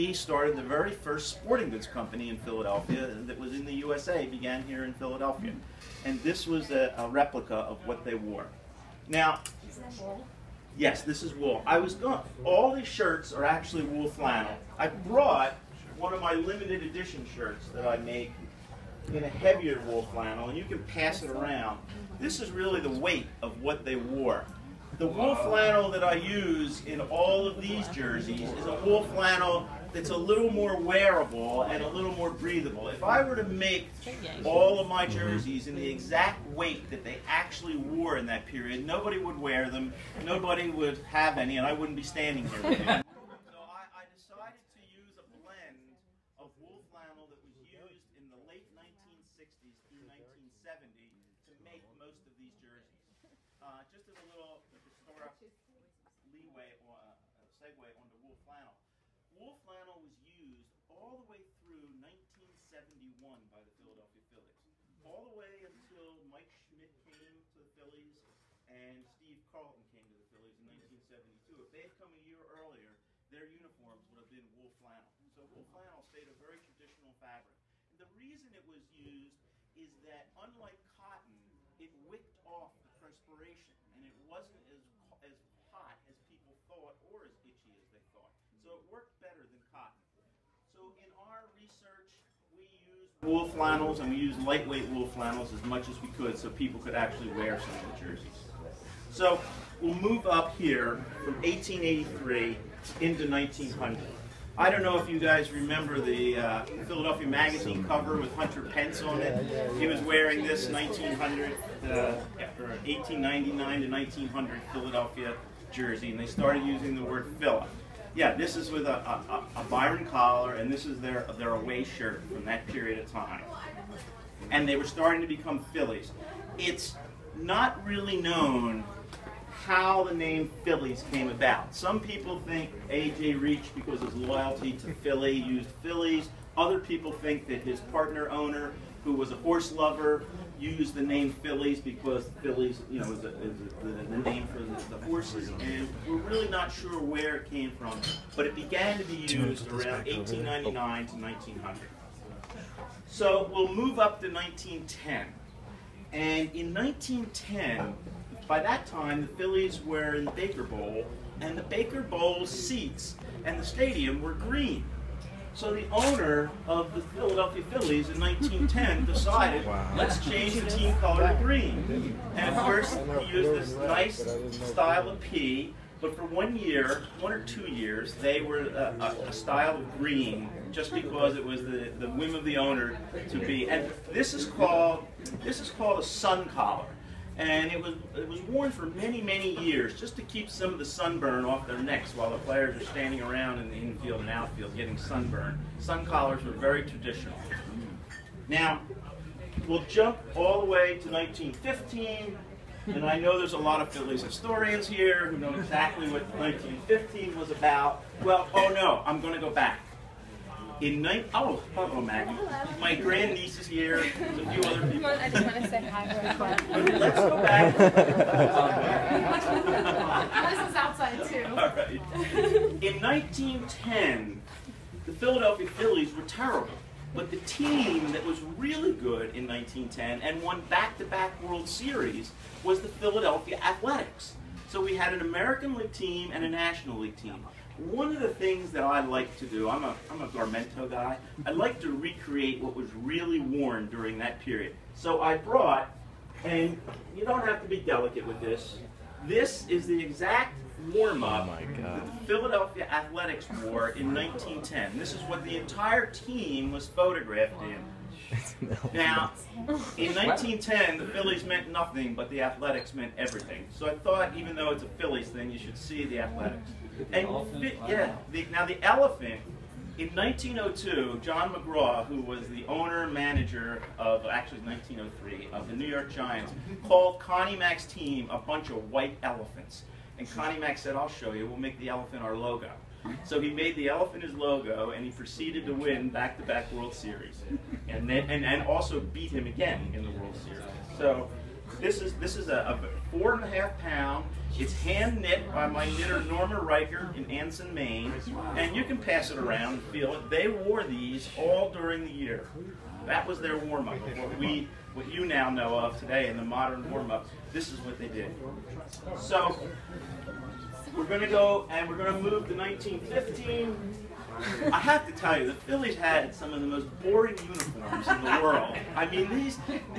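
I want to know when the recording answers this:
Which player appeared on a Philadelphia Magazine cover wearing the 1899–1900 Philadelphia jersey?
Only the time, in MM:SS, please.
01:48.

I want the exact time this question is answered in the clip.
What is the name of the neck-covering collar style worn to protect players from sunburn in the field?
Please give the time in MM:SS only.
03:06.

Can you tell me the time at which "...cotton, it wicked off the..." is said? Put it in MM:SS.
01:20.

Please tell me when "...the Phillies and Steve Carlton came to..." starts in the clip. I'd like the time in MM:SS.
01:07.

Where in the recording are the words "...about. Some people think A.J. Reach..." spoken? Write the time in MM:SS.
02:11.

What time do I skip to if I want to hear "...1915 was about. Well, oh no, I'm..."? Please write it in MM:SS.
03:26.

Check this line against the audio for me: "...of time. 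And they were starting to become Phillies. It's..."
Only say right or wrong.
right.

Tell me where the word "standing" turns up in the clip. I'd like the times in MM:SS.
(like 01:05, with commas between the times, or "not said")
00:42, 03:12.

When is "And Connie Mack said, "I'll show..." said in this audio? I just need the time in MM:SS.
04:40.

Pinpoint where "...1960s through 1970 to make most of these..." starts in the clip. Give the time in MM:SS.
00:48.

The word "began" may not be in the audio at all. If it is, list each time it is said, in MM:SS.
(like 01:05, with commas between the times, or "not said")
00:04, 02:28.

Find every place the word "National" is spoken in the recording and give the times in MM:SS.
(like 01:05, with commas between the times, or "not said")
03:56.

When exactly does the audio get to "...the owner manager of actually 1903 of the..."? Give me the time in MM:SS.
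04:32.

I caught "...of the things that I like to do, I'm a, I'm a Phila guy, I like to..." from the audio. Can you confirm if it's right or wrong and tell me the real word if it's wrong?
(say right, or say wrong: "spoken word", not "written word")
wrong: "Garmento", not "Phila".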